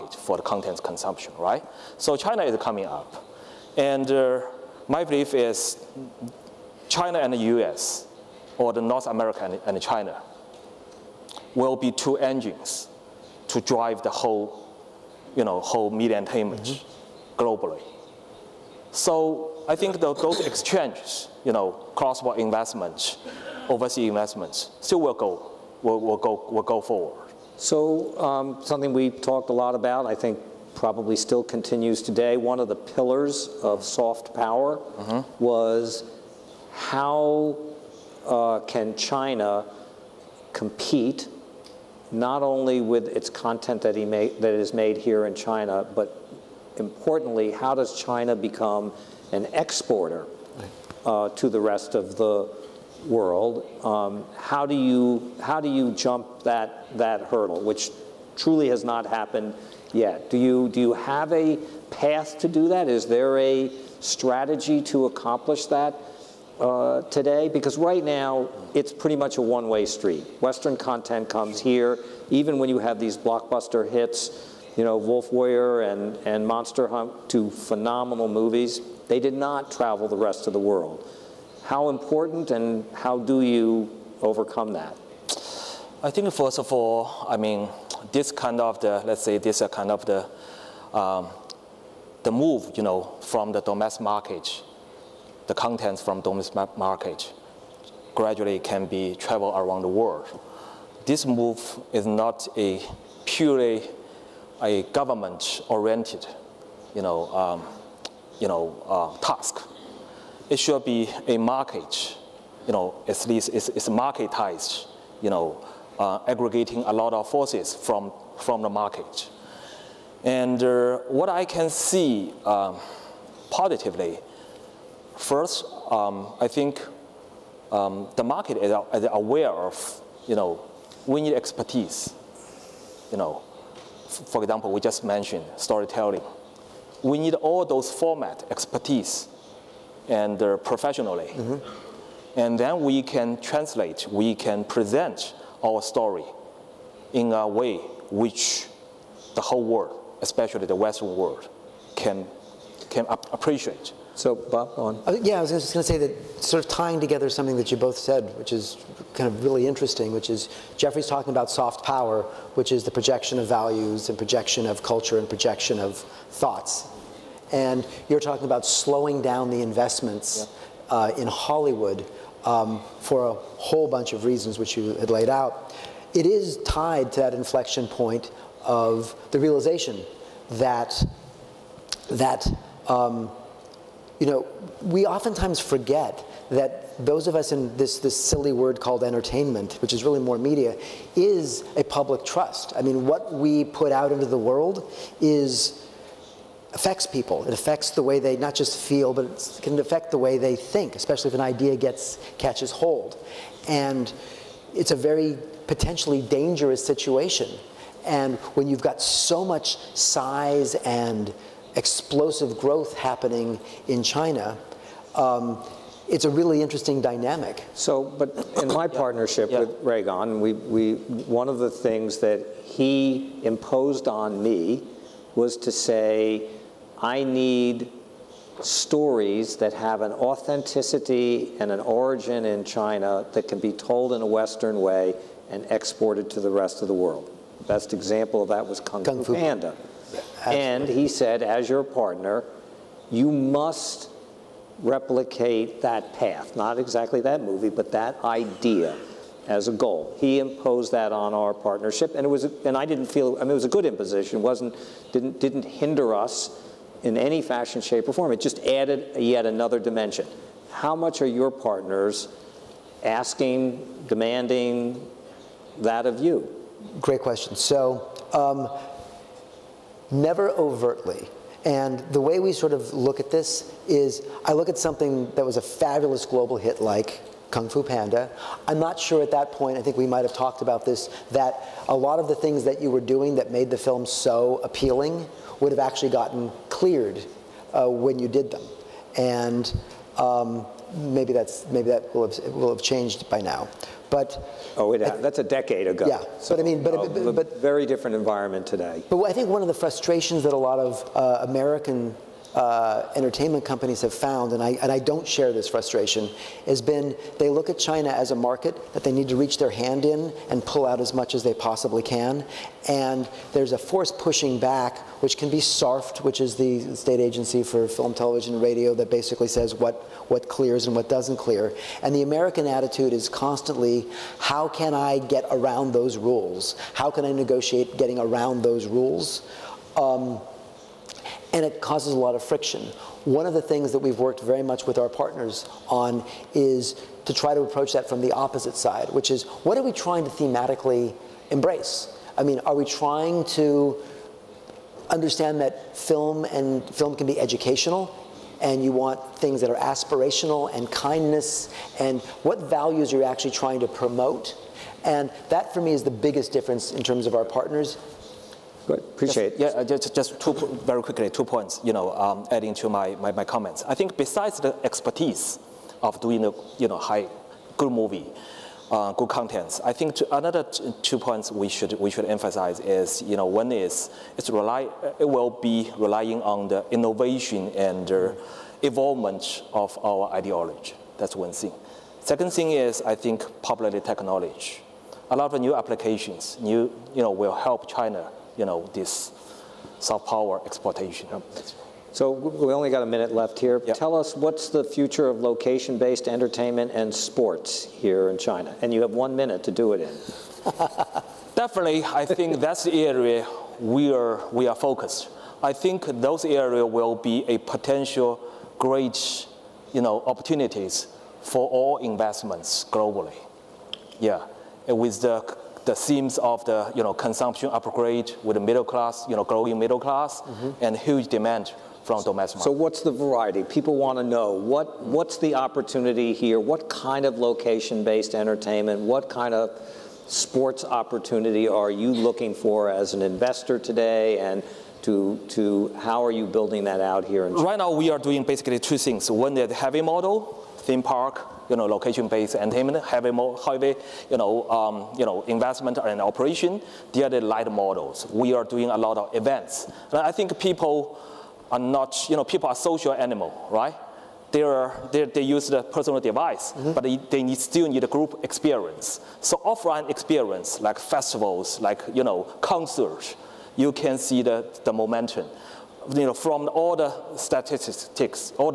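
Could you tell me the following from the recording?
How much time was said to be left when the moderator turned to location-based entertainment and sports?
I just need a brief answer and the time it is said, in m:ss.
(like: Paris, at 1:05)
a minute, at 6:33.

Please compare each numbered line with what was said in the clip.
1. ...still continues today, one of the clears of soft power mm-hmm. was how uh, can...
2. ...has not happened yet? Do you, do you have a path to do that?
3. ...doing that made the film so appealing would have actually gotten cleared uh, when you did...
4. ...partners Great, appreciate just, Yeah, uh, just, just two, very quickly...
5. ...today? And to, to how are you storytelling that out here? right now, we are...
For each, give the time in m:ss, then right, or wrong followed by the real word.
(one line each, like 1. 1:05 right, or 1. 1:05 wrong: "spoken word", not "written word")
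1. 0:31 wrong: "pillars", not "clears"
2. 0:58 right
3. 4:42 right
4. 5:57 right
5. 7:13 wrong: "building", not "storytelling".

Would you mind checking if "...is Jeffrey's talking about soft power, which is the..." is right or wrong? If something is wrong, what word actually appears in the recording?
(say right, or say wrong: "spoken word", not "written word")
right.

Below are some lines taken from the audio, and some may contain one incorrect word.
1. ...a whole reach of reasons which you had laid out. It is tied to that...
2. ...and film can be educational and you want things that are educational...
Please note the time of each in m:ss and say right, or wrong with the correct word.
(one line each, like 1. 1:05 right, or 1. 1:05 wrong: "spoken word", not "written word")
1. 2:53 wrong: "bunch", not "reach"
2. 5:46 wrong: "aspirational", not "educational".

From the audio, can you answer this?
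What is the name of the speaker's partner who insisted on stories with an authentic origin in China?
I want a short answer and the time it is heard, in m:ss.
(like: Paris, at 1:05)
Ruigang, at 3:39.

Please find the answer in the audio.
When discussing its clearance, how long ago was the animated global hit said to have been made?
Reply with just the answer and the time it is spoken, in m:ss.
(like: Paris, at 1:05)
a decade ago, at 4:55.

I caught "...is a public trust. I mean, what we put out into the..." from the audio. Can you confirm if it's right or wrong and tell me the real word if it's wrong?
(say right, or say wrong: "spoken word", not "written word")
right.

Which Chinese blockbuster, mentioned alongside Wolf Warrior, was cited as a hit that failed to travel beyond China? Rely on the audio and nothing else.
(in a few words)
Monster Hunt.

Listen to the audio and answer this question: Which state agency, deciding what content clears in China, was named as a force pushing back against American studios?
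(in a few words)
SARFT.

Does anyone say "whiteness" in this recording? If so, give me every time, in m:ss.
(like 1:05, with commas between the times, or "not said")
not said.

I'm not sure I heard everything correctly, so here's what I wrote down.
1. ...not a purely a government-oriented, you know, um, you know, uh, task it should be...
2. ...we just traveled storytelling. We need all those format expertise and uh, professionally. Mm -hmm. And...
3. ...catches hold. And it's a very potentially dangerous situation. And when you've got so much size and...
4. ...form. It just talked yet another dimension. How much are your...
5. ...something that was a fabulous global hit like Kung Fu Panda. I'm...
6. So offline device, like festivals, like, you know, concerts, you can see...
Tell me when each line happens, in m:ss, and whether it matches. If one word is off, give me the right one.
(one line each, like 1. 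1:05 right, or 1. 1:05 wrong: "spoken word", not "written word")
1. 1:42 right
2. 2:14 wrong: "mentioned", not "traveled"
3. 3:22 right
4. 4:18 wrong: "added", not "talked"
5. 4:34 right
6. 7:39 wrong: "experience", not "device".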